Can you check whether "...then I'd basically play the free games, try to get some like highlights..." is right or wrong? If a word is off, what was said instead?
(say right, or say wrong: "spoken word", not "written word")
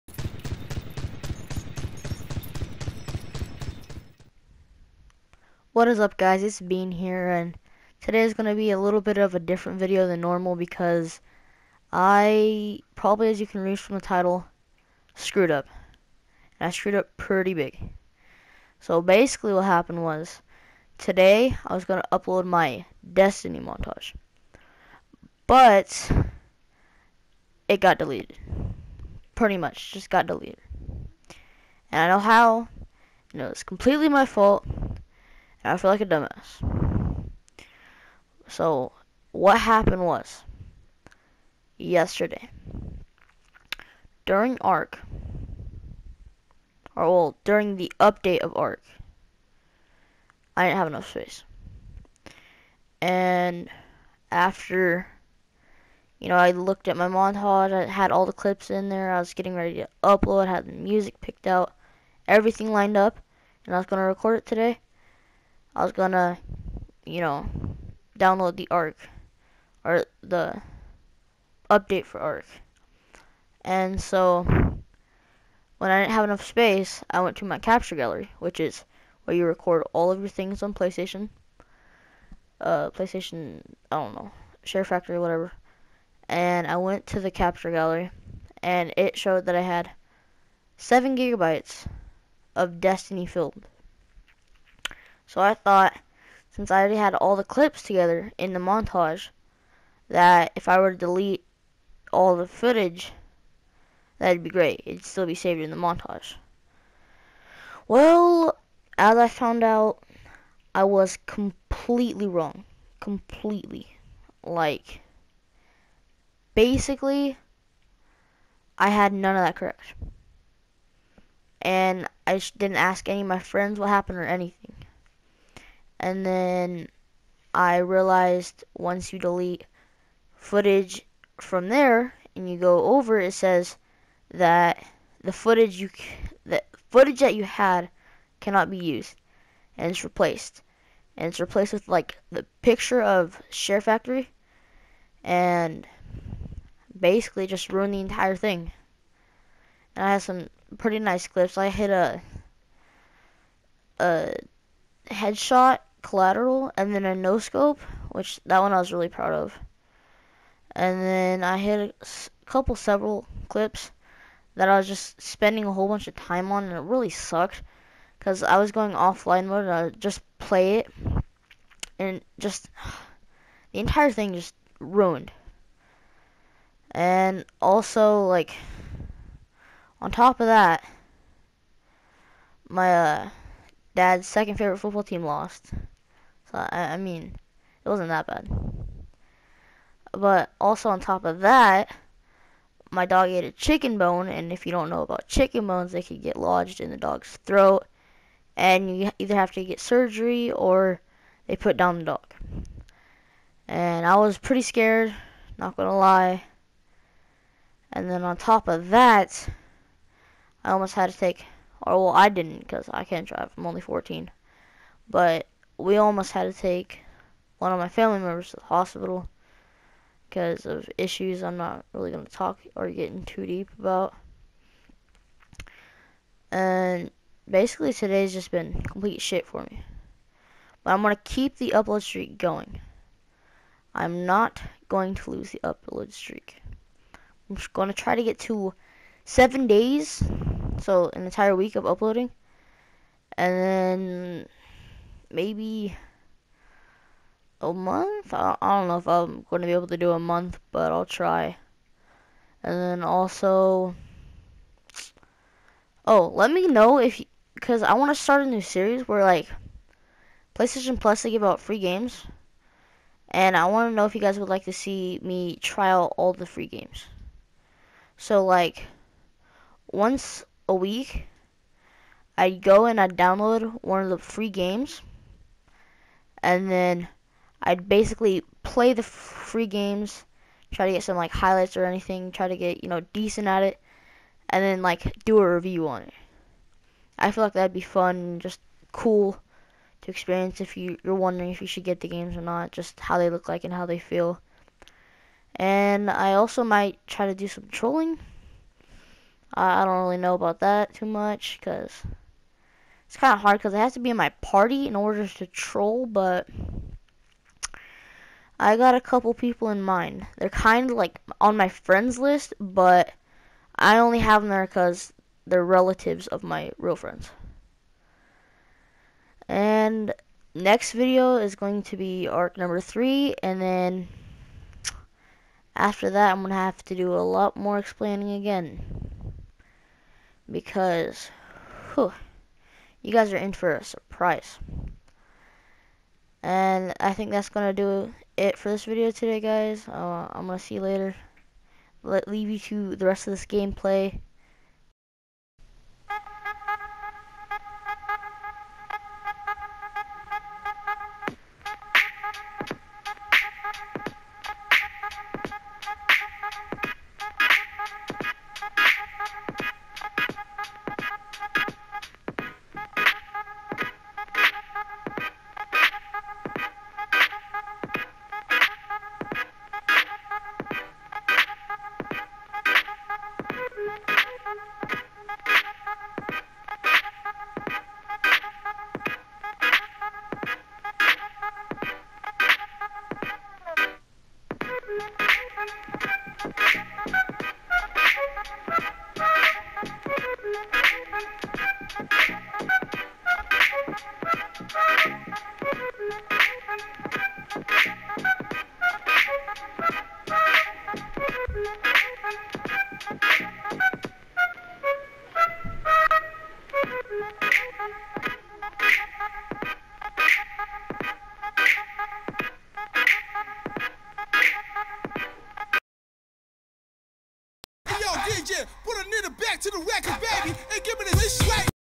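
right.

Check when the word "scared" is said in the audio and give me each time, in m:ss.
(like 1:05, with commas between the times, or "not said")
3:24.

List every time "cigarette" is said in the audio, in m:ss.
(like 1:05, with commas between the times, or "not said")
not said.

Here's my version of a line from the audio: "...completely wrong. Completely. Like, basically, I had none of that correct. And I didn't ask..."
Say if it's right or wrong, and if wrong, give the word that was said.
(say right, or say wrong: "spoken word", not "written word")
right.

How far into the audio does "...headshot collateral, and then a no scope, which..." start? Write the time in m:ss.
2:35.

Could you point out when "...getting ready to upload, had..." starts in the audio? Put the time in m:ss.
0:59.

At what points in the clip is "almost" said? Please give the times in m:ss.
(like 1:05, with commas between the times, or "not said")
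3:30, 3:35.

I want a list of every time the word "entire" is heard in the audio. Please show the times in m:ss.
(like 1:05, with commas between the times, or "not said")
2:27, 2:53, 4:01.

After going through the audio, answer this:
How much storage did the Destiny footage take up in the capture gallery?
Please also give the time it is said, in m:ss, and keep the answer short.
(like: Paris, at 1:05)
7 gigabytes, at 1:30.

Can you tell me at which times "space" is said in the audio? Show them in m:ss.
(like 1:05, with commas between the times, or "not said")
0:51, 1:16.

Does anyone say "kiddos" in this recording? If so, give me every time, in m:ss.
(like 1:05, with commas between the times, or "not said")
not said.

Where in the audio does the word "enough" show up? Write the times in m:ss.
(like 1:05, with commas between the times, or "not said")
0:50, 1:16.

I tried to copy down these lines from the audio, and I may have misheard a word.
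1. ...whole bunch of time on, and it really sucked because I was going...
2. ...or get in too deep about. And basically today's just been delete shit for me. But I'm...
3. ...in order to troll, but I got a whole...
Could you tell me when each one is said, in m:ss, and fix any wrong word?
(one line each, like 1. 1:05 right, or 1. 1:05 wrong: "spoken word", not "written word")
1. 2:45 right
2. 3:42 wrong: "complete", not "delete"
3. 5:04 wrong: "couple", not "whole".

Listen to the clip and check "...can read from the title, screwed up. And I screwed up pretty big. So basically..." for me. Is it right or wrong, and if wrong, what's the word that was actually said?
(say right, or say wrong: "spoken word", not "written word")
right.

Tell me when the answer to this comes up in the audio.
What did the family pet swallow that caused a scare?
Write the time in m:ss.
3:13.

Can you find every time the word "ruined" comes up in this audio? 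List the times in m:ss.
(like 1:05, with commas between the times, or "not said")
2:27, 2:54.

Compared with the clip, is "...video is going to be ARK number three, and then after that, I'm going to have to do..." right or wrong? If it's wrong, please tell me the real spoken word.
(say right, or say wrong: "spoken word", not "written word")
right.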